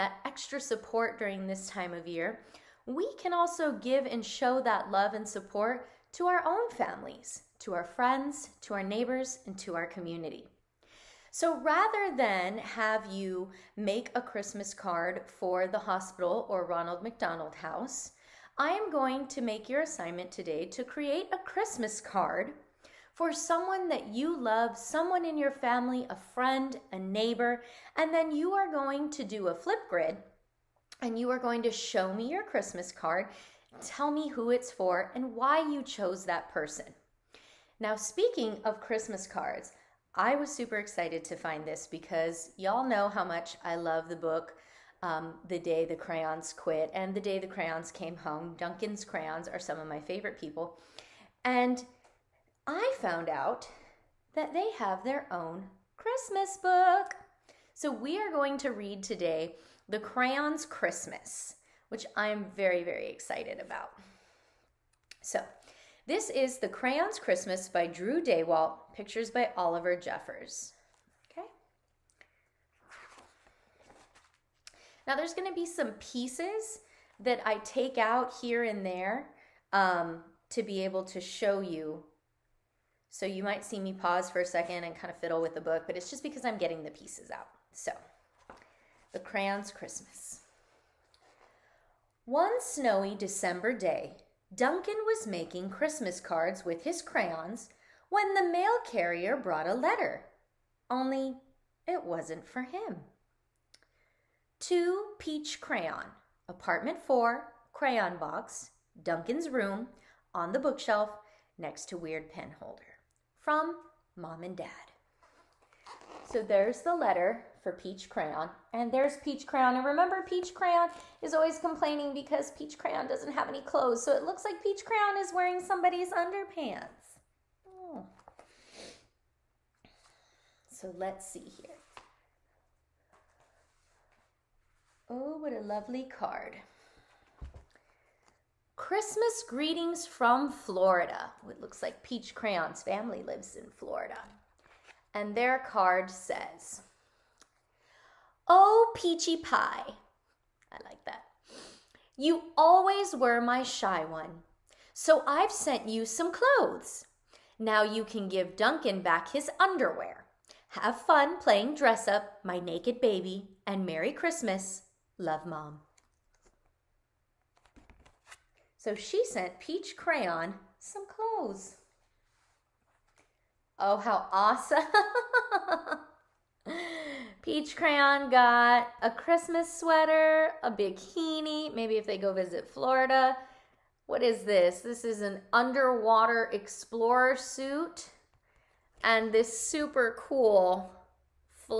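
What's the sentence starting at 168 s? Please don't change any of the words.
So she sent Peach Crayon some clothes.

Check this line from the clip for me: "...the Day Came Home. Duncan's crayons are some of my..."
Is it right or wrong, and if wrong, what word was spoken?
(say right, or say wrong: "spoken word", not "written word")
wrong: "Crayons", not "Day".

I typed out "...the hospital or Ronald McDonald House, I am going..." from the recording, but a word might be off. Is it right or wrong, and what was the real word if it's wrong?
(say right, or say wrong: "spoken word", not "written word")
right.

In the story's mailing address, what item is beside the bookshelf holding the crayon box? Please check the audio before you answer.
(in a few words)
Weird Pen Holder.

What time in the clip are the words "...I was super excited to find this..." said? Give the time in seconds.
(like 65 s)
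40 s.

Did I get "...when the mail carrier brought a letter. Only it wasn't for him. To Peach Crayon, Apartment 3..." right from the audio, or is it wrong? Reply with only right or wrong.
wrong.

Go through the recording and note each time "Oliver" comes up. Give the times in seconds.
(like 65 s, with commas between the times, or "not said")
69 s.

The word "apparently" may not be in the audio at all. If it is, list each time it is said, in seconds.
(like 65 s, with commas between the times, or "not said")
not said.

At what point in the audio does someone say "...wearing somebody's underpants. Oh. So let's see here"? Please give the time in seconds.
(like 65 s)
125 s.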